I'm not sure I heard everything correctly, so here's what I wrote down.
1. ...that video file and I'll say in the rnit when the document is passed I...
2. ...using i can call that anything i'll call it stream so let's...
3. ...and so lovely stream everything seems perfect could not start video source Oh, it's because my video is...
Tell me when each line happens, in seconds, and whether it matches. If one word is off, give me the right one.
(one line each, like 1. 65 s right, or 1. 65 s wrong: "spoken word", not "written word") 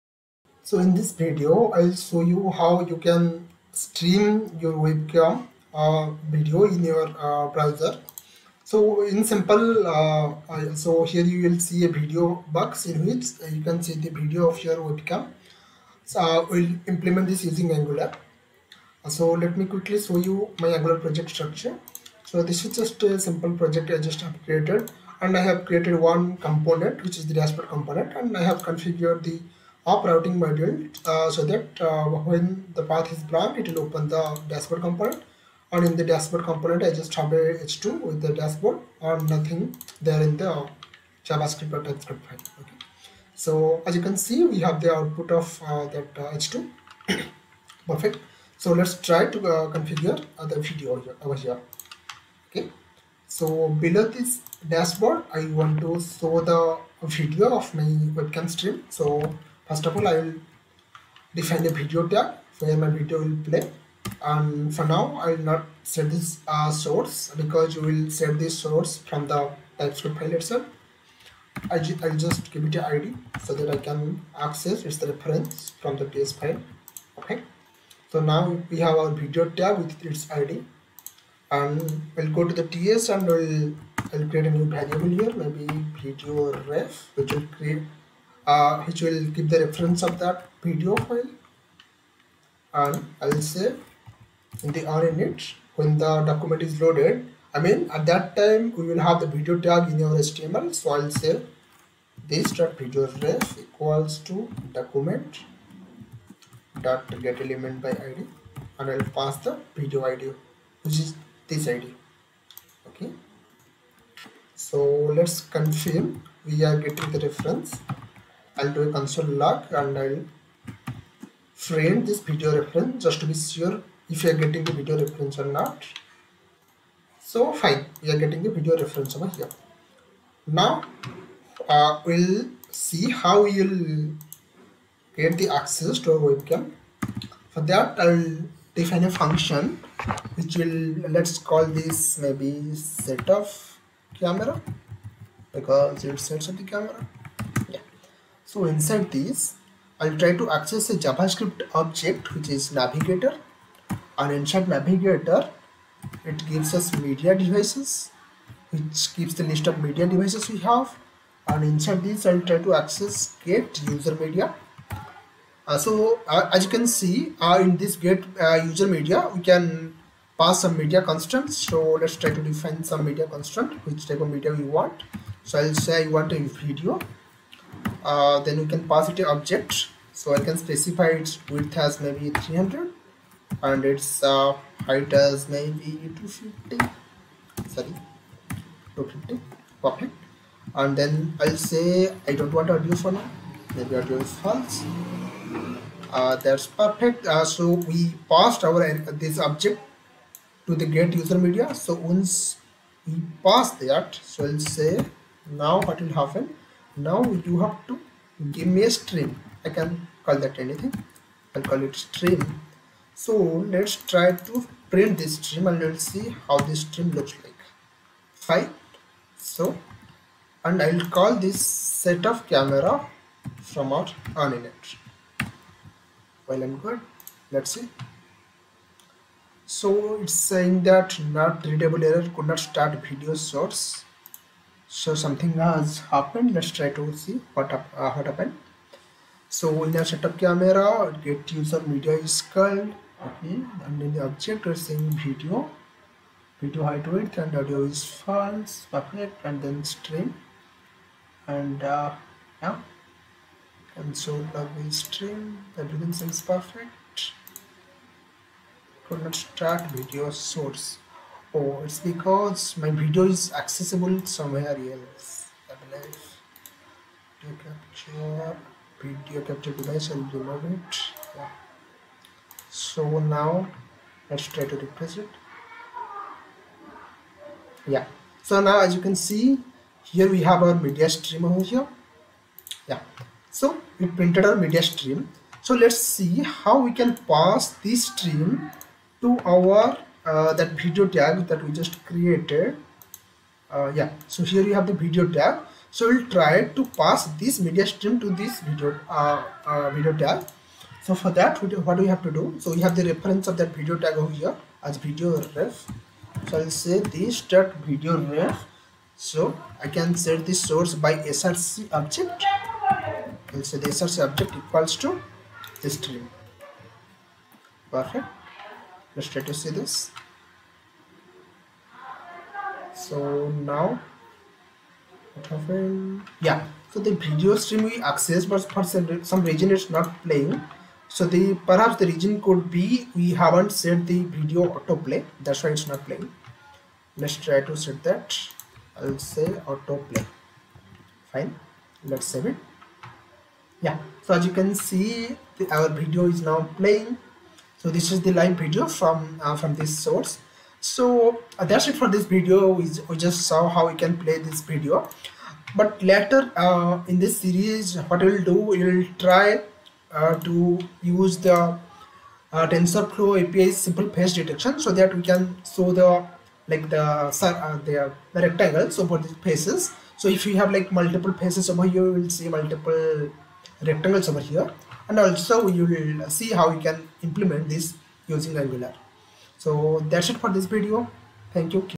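1. 90 s wrong: "loaded", not "passed"
2. 208 s wrong: "string", not "using"
3. 253 s right.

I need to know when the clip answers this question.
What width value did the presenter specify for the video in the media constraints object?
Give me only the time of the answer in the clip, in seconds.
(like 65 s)
182 s.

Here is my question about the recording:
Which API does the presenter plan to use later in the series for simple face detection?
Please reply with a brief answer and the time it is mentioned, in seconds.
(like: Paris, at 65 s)
TensorFlow, at 362 s.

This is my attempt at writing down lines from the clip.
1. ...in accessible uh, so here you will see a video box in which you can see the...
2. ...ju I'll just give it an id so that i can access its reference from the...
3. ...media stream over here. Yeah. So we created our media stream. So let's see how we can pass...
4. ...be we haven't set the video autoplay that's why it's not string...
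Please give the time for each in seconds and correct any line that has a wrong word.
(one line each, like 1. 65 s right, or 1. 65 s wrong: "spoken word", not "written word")
1. 9 s wrong: "simple", not "accessible"
2. 71 s right
3. 280 s wrong: "printed", not "created"
4. 332 s wrong: "playing", not "string".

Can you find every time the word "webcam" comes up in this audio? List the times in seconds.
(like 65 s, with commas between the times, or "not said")
4 s, 14 s, 58 s, 136 s.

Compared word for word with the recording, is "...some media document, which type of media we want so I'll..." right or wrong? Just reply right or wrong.
wrong.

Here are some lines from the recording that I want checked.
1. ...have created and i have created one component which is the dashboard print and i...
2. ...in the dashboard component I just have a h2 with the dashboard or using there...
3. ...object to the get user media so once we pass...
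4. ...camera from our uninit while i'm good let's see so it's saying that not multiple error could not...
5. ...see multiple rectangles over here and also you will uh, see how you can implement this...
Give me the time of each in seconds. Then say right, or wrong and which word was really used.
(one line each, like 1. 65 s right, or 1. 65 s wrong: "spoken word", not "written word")
1. 24 s wrong: "component", not "print"
2. 35 s wrong: "nothing", not "using"
3. 199 s right
4. 222 s wrong: "readable", not "multiple"
5. 372 s right.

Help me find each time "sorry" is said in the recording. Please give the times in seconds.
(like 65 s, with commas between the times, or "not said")
187 s.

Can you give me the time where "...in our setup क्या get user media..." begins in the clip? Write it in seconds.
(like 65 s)
239 s.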